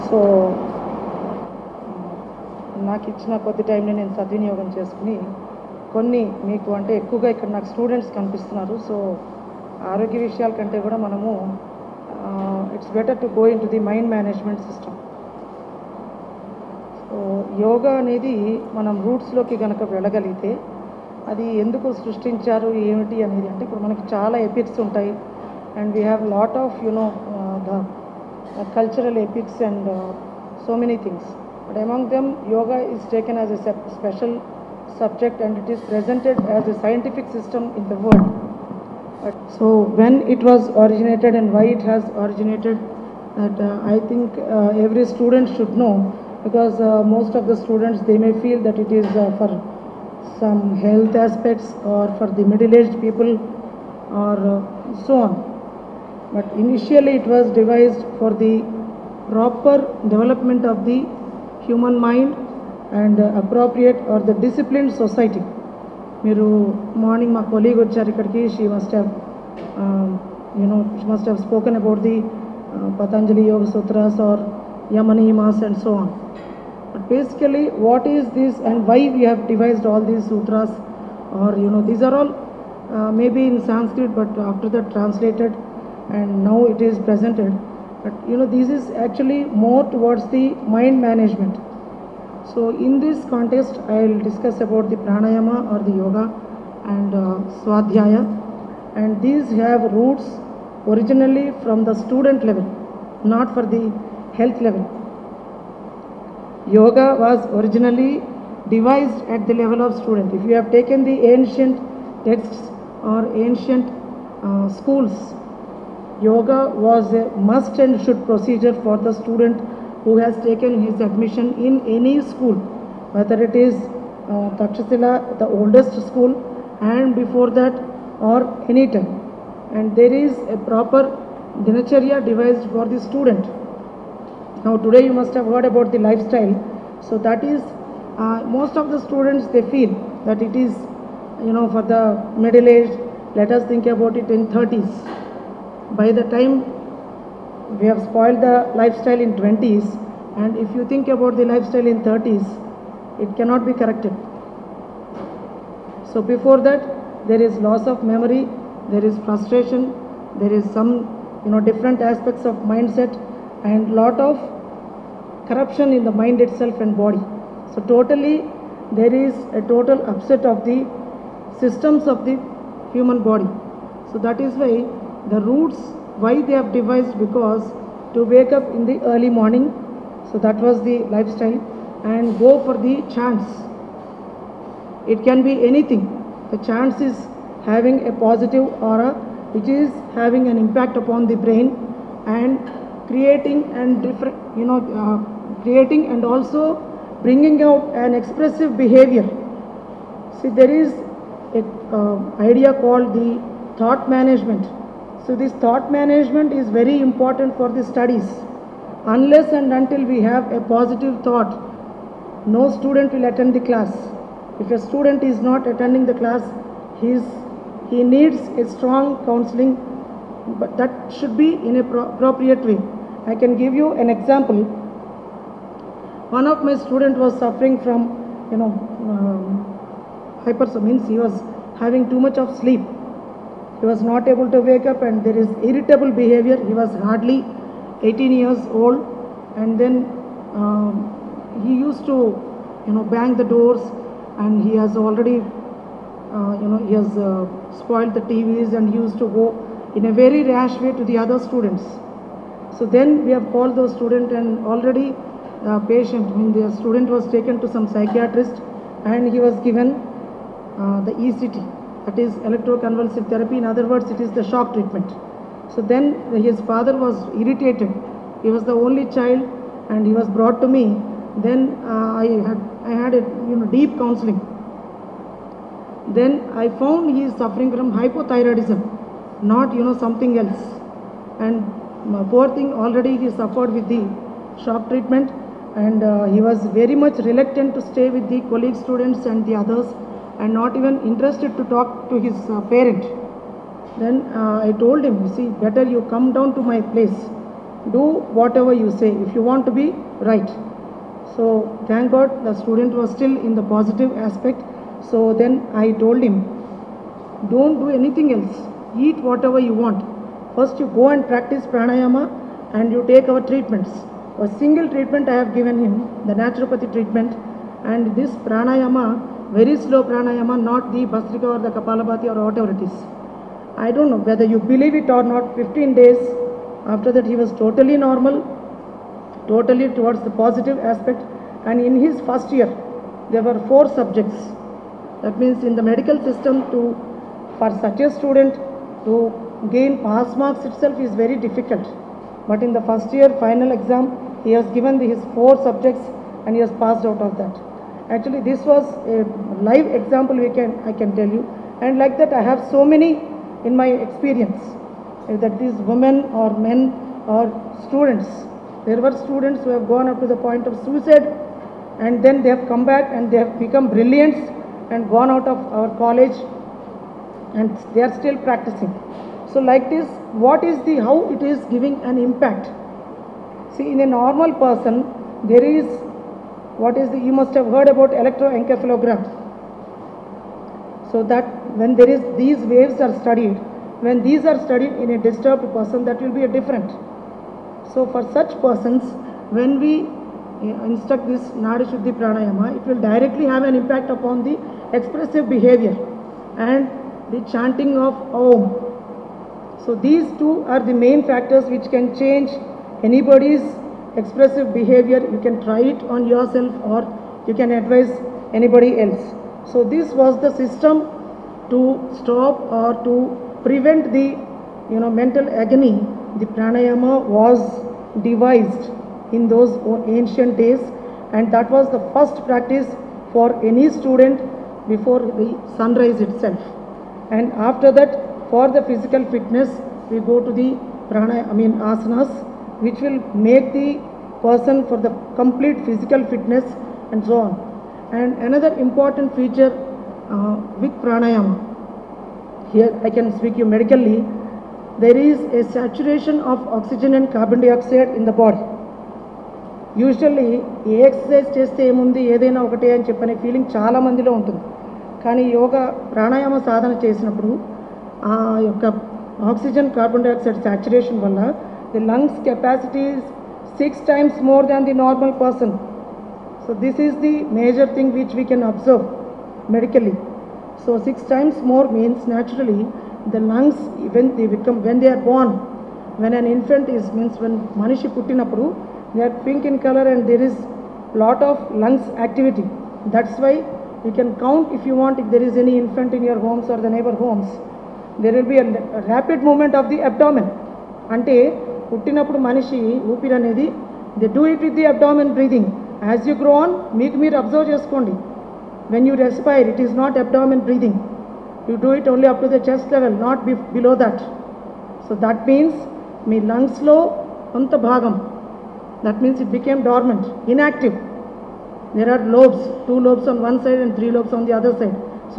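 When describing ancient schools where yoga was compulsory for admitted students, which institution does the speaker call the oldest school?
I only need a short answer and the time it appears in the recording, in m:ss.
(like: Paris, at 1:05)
Takshasila, at 2:04.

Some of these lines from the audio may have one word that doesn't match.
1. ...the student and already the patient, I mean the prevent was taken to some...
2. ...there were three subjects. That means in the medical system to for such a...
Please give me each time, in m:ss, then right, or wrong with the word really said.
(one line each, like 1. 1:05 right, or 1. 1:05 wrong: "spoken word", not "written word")
1. 4:13 wrong: "student", not "prevent"
2. 5:33 wrong: "four", not "three".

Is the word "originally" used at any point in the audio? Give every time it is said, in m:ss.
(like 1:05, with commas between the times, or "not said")
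1:40, 1:47.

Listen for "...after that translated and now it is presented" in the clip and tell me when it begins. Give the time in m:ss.
1:24.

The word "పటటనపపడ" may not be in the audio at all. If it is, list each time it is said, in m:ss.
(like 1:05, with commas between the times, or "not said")
7:58, 8:11.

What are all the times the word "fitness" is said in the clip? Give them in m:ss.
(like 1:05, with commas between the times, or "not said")
7:09, 7:16.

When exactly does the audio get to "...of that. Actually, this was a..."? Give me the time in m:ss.
5:47.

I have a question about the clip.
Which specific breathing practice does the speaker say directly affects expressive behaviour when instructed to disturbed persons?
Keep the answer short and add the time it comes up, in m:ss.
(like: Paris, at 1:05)
Nadi Shuddhi Pranayama, at 6:31.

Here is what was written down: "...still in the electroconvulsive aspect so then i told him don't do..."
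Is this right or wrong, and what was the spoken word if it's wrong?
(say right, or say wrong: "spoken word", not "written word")
wrong: "positive", not "electroconvulsive".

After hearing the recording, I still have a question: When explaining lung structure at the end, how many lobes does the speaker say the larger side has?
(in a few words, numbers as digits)
3.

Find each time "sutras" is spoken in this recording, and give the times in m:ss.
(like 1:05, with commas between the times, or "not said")
1:13, 1:20.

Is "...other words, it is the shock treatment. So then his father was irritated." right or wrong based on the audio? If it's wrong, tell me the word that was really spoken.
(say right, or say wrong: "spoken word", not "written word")
right.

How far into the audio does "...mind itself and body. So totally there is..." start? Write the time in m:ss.
2:46.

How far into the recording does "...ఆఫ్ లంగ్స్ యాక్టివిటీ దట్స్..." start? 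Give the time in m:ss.
8:01.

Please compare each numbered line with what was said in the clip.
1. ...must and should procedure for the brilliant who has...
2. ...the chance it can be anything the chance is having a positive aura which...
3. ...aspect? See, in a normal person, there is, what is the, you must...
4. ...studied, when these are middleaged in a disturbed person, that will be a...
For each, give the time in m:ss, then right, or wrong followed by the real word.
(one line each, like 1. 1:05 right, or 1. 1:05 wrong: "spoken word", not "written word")
1. 1:57 wrong: "student", not "brilliant"
2. 3:02 right
3. 6:12 wrong: "impact", not "aspect"
4. 6:23 wrong: "studied", not "middleaged".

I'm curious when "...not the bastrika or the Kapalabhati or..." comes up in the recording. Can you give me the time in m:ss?
5:20.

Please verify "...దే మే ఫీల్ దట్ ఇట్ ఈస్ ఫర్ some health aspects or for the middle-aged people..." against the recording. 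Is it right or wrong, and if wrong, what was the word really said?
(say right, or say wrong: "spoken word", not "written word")
right.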